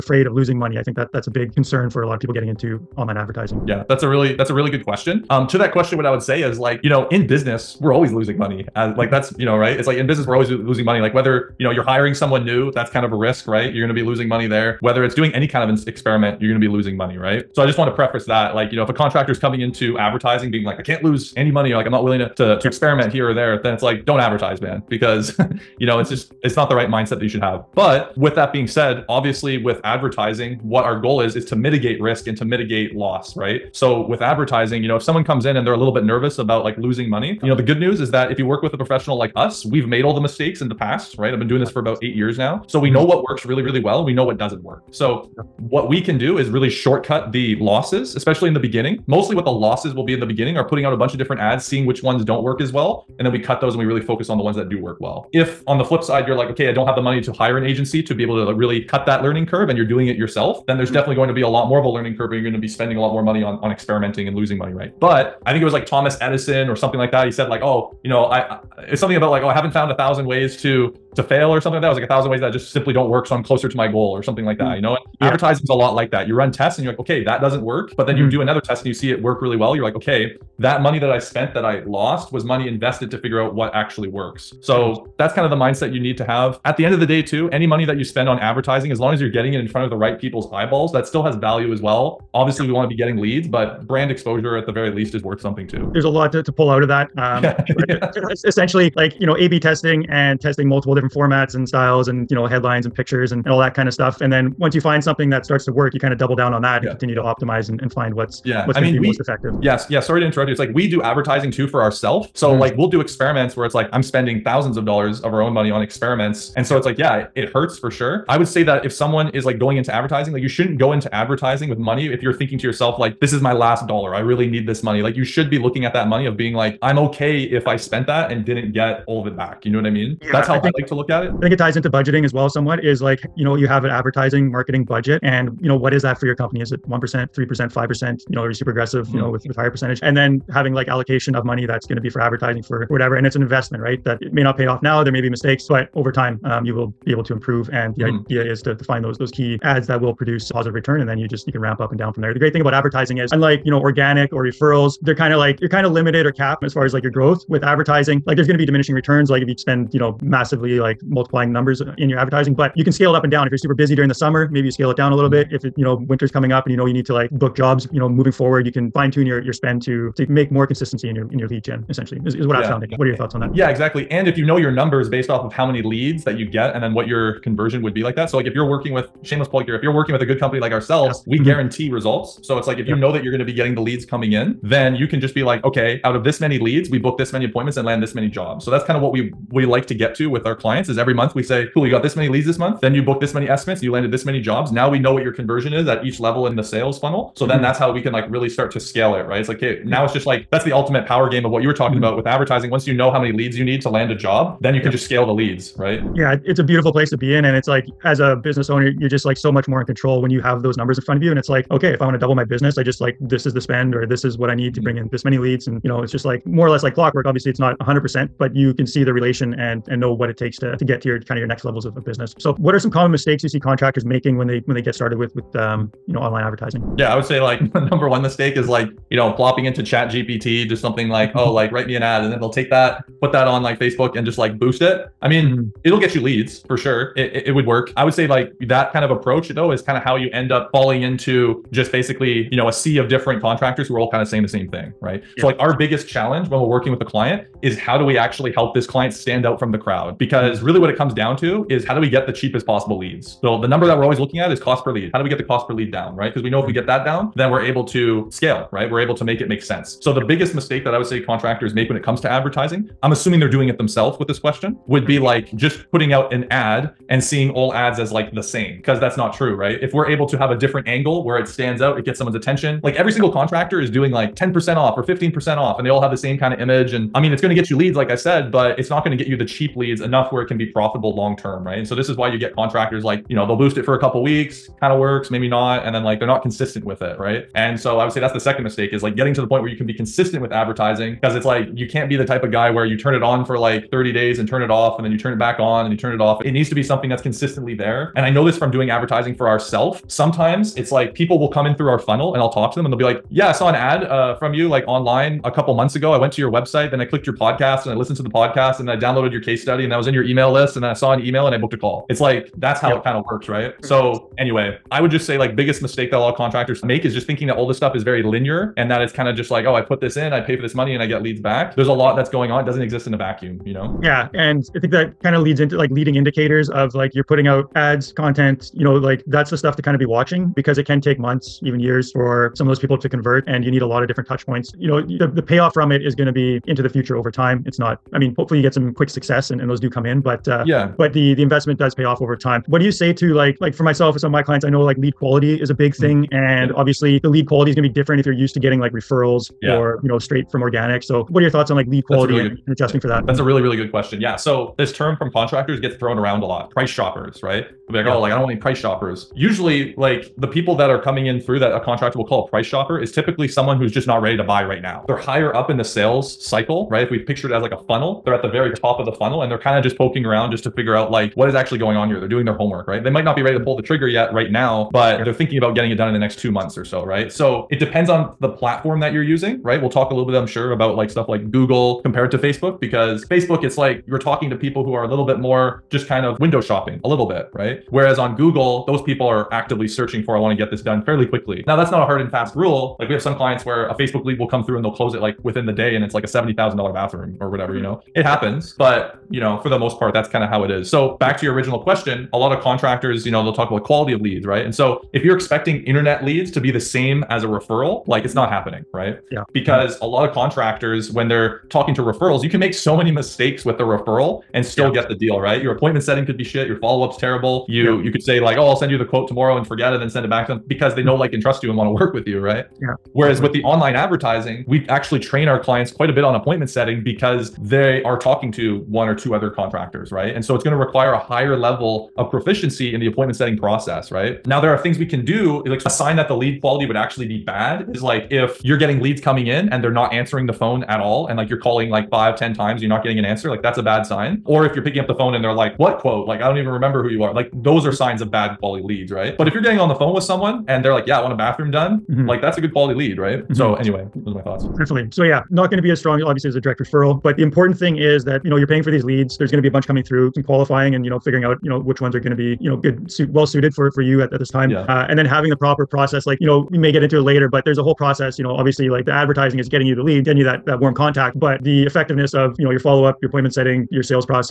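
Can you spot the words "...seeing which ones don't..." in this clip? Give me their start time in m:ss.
0:51.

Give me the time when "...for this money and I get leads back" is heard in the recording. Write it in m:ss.
5:20.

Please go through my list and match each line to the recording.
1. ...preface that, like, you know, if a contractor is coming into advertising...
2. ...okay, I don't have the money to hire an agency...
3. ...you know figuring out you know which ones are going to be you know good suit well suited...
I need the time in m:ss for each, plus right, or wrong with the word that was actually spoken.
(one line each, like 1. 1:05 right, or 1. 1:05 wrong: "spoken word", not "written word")
1. 0:17 right
2. 0:56 right
3. 7:41 right.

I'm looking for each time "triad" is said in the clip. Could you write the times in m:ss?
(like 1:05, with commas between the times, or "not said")
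not said.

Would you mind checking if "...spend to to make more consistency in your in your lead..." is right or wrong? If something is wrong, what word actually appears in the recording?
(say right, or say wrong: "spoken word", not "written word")
right.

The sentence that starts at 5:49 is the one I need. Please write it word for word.
or you know straight from organic.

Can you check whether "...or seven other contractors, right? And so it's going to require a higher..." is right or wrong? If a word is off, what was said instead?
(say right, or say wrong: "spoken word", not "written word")
wrong: "two", not "seven".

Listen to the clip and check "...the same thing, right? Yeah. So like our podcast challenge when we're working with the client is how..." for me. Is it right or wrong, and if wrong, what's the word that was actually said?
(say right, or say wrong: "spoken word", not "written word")
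wrong: "biggest", not "podcast".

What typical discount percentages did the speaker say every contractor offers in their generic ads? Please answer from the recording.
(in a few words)
10% or 15% off.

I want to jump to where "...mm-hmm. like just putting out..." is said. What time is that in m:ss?
4:25.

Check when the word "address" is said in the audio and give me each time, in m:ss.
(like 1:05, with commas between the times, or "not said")
not said.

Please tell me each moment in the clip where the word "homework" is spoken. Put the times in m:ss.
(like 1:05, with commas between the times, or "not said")
6:12.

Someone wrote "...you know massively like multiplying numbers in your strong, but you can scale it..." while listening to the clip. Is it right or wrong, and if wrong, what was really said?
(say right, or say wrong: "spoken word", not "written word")
wrong: "advertising", not "strong".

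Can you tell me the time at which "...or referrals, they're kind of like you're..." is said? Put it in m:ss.
2:34.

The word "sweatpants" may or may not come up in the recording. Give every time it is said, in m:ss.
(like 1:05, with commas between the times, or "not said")
not said.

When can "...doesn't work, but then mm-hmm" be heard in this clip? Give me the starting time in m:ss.
1:17.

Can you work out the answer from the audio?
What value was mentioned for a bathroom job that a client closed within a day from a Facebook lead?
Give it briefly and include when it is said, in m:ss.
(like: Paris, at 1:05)
$70,000, at 6:36.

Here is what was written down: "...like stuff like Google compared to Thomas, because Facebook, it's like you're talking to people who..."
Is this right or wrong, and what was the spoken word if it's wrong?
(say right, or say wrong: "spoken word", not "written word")
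wrong: "Facebook", not "Thomas".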